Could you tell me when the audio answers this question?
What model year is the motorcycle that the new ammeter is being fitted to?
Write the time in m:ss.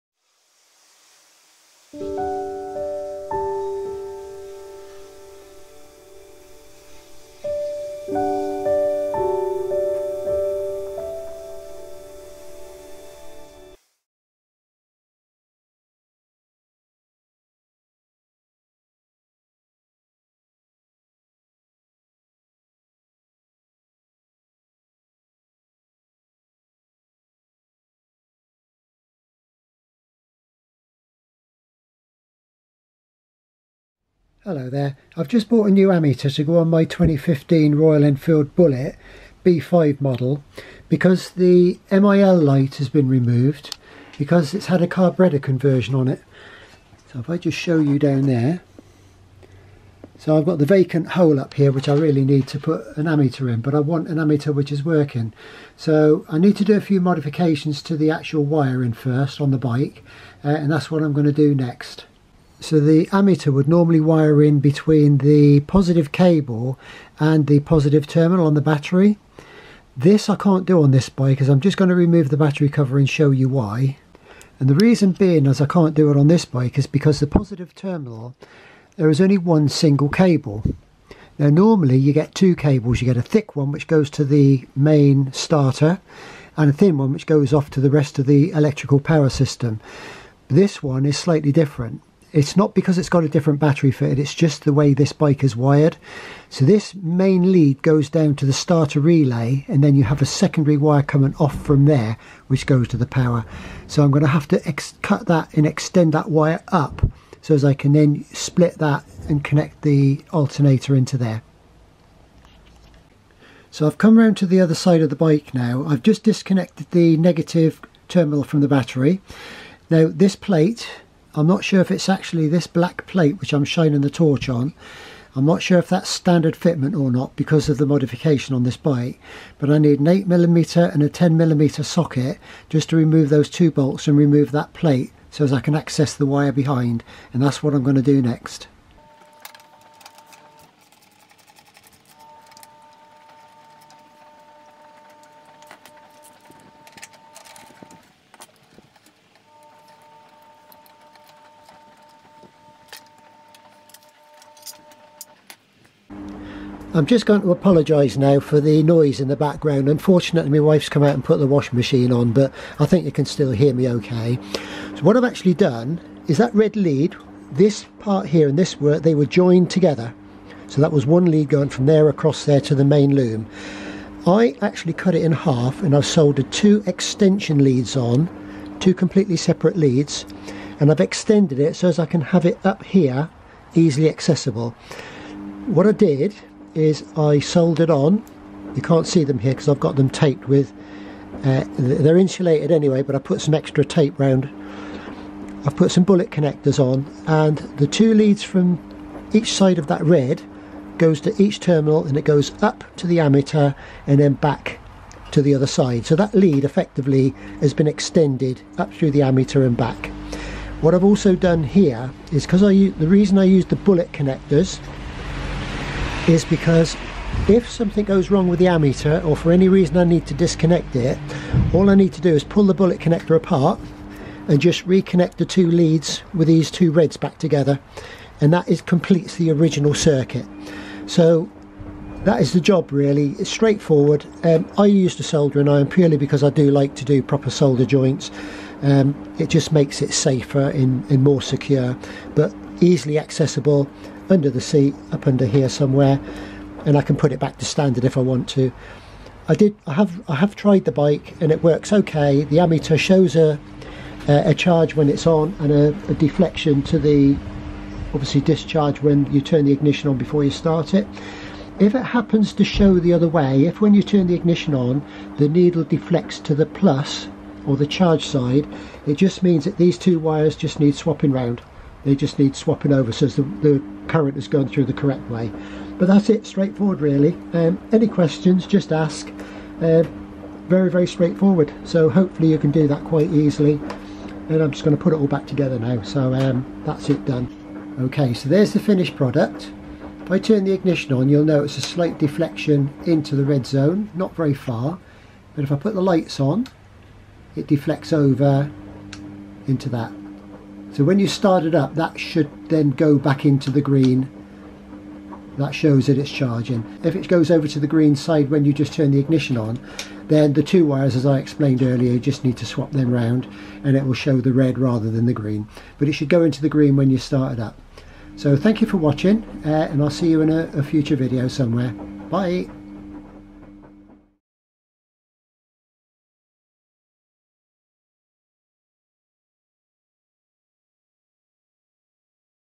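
0:36.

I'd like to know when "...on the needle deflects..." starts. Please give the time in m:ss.
4:24.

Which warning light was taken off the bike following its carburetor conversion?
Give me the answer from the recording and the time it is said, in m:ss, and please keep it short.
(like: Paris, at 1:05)
MIL light, at 0:41.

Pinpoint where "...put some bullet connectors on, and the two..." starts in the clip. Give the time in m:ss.
3:15.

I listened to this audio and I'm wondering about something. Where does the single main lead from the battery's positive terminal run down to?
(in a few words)
starter relay.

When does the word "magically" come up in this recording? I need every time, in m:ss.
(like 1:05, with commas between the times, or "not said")
not said.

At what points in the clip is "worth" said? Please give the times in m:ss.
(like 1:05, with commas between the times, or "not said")
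not said.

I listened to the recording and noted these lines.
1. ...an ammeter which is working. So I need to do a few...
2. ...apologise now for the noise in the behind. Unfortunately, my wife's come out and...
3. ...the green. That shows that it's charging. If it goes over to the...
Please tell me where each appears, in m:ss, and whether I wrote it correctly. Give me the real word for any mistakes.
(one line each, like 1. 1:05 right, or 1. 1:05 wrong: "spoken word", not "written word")
1. 0:54 right
2. 2:37 wrong: "background", not "behind"
3. 5:03 right.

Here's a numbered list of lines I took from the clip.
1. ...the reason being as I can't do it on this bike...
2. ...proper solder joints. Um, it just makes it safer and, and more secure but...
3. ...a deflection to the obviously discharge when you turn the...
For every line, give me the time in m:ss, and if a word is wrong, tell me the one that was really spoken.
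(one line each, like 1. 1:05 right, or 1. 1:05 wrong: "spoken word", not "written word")
1. 1:14 right
2. 3:57 right
3. 4:16 right.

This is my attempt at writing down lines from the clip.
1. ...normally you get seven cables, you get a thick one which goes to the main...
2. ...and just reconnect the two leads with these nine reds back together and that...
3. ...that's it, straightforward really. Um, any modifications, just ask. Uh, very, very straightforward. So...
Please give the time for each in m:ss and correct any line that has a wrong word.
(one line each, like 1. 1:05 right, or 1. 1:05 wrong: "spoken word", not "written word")
1. 1:21 wrong: "two", not "seven"
2. 3:44 wrong: "two", not "nine"
3. 4:36 wrong: "questions", not "modifications".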